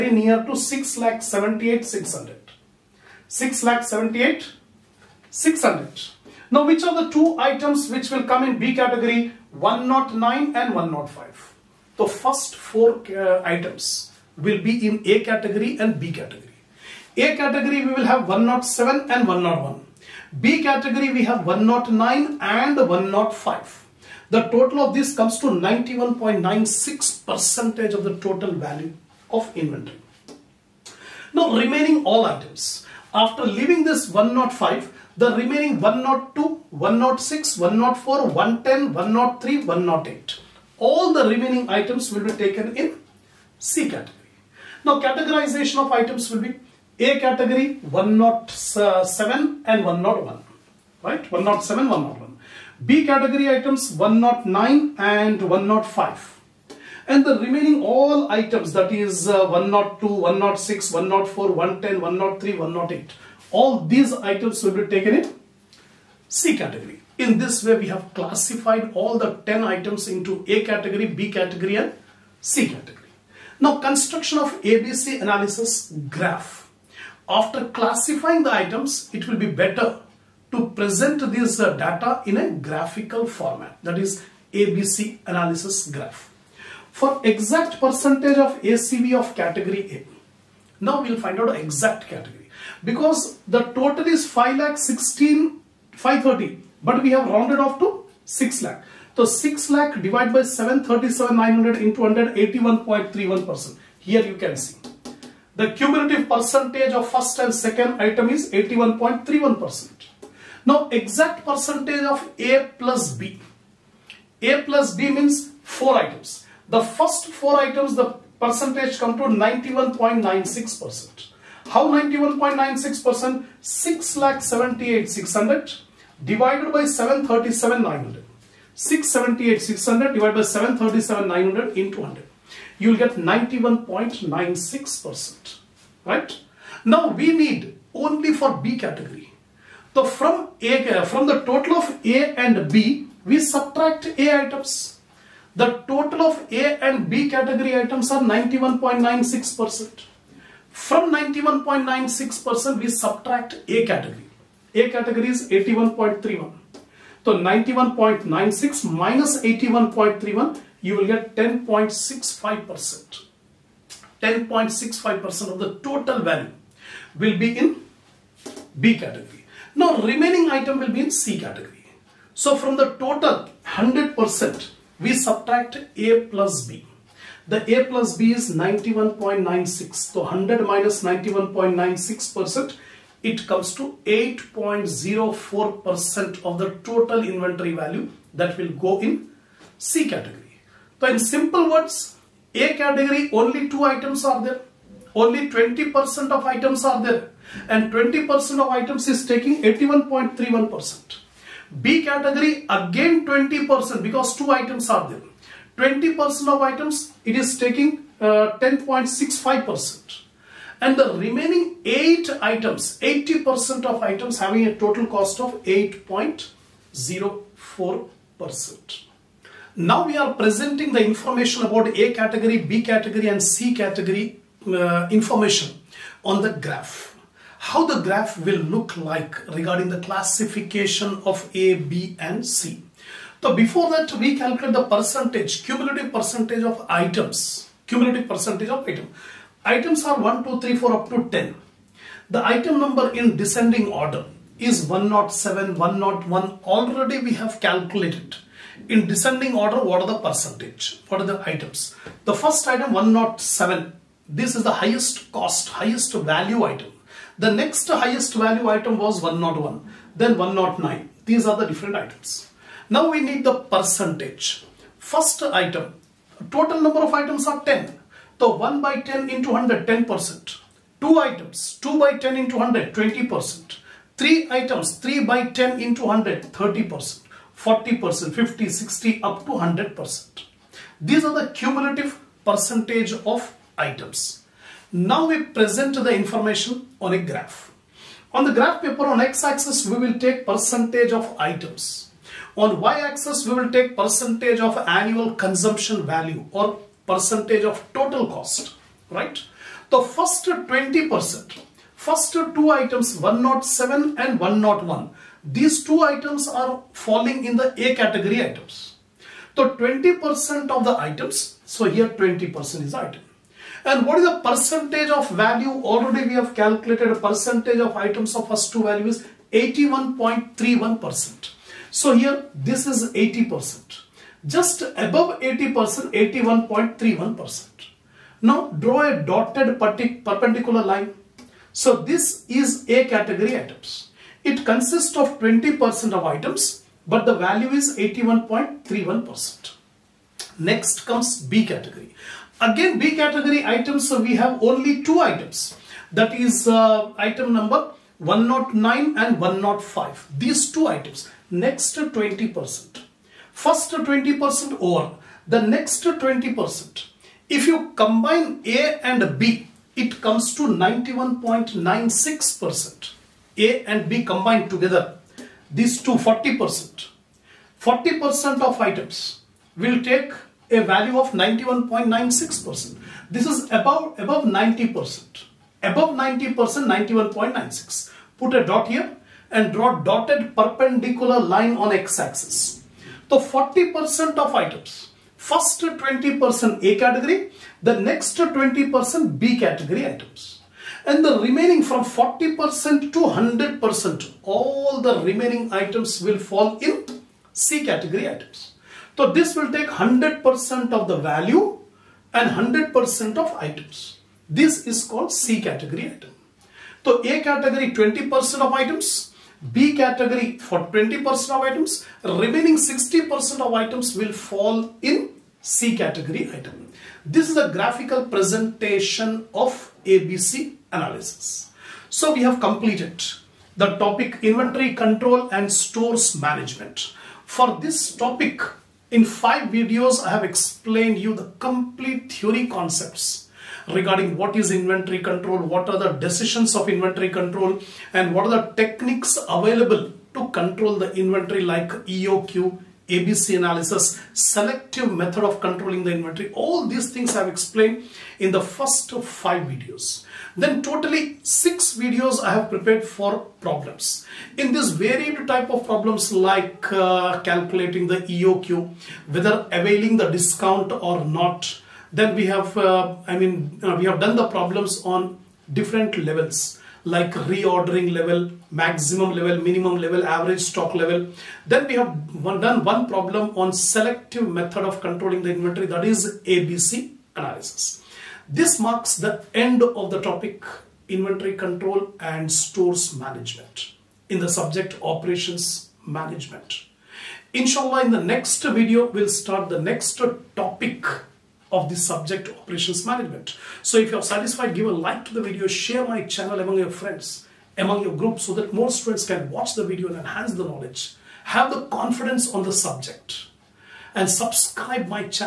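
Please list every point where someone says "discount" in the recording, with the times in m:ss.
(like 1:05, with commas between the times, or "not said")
7:40.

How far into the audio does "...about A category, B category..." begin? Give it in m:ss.
3:41.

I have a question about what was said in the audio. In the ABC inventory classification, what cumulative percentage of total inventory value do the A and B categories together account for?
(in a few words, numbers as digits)
91.96%.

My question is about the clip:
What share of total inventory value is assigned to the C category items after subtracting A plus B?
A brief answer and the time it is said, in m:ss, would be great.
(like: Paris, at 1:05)
8.04%, at 3:04.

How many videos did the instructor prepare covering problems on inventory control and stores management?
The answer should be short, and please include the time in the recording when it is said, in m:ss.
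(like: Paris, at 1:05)
6, at 7:31.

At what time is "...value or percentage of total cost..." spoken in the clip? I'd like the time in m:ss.
4:56.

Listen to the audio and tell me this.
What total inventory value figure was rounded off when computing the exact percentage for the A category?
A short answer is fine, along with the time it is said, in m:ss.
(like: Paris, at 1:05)
516,530, at 1:34.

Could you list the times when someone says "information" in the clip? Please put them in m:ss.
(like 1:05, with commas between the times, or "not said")
3:41, 3:45, 4:46.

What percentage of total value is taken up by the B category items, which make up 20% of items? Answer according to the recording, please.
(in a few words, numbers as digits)
10.65%.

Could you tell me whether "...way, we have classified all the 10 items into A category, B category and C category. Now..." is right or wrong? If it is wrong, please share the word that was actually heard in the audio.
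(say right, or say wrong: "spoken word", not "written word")
right.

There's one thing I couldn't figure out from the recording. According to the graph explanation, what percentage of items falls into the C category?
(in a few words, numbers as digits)
60%.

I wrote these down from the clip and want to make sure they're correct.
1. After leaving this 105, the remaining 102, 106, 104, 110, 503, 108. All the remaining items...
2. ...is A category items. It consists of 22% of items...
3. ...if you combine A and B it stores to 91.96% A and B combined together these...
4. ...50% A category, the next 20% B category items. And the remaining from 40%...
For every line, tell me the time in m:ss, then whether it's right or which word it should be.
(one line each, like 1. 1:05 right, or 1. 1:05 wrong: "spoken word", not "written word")
1. 0:33 wrong: "103", not "503"
2. 5:32 wrong: "20", not "22"
3. 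5:57 wrong: "comes", not "stores"
4. 6:25 wrong: "20", not "50".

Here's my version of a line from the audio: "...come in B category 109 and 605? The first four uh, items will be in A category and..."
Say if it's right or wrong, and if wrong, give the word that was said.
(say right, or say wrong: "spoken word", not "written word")
wrong: "105", not "605".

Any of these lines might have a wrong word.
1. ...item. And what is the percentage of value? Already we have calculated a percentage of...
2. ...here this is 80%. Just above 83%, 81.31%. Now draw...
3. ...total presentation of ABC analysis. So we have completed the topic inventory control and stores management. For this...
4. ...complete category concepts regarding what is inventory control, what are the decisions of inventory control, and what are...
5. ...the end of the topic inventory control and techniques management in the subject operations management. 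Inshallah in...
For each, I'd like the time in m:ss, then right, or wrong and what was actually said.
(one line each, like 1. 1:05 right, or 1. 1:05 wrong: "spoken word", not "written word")
1. 5:12 right
2. 5:22 wrong: "80", not "83"
3. 6:57 wrong: "graphical", not "total"
4. 7:11 wrong: "theory", not "category"
5. 7:59 wrong: "stores", not "techniques".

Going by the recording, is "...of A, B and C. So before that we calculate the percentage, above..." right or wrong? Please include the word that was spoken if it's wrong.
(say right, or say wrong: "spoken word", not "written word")
wrong: "cumulative", not "above".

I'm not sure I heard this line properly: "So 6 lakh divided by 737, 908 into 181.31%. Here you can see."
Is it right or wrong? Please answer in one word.
wrong.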